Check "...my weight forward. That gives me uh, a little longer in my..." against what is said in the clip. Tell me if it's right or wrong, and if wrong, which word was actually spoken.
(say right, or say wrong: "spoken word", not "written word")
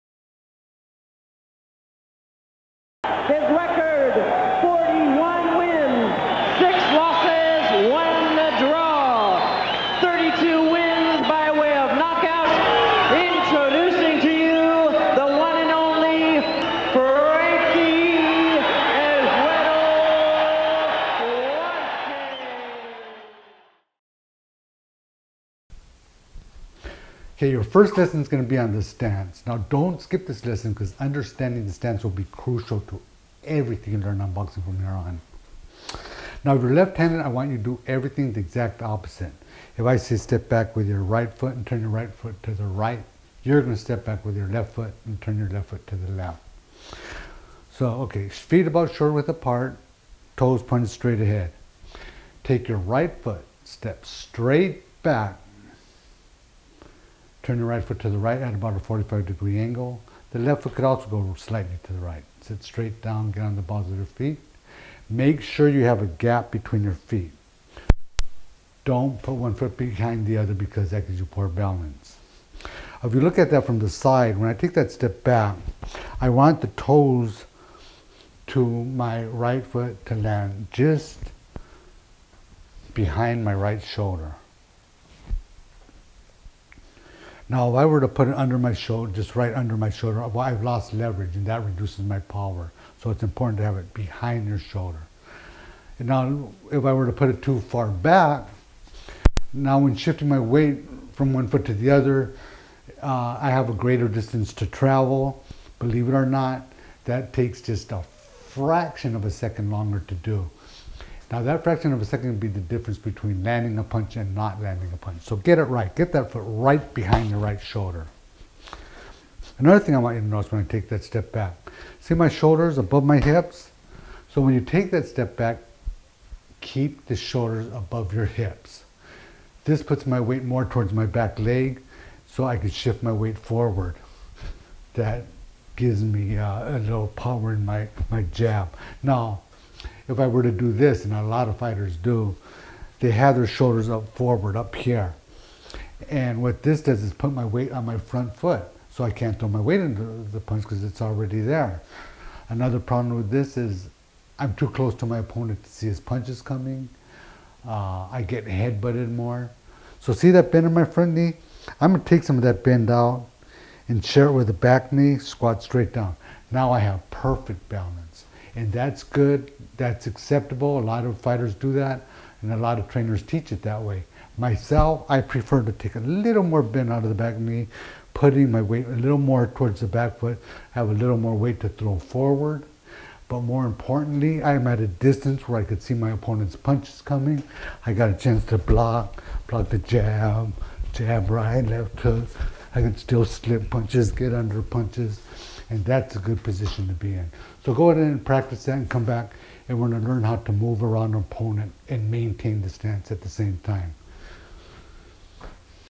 wrong: "power", not "longer".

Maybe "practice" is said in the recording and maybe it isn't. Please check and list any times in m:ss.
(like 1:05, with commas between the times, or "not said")
3:18.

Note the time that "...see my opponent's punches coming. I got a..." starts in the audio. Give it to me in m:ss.
3:05.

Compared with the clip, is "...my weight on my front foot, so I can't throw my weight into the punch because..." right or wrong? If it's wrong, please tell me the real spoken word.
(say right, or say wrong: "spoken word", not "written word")
right.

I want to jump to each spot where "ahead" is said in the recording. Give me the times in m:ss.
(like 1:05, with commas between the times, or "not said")
0:51, 3:17.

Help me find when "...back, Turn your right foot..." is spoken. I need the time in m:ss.
0:55.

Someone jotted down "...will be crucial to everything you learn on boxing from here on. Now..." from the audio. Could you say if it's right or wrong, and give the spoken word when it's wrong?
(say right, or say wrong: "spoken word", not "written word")
right.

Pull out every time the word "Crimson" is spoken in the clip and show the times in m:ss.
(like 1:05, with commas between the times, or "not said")
not said.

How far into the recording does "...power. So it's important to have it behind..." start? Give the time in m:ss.
1:32.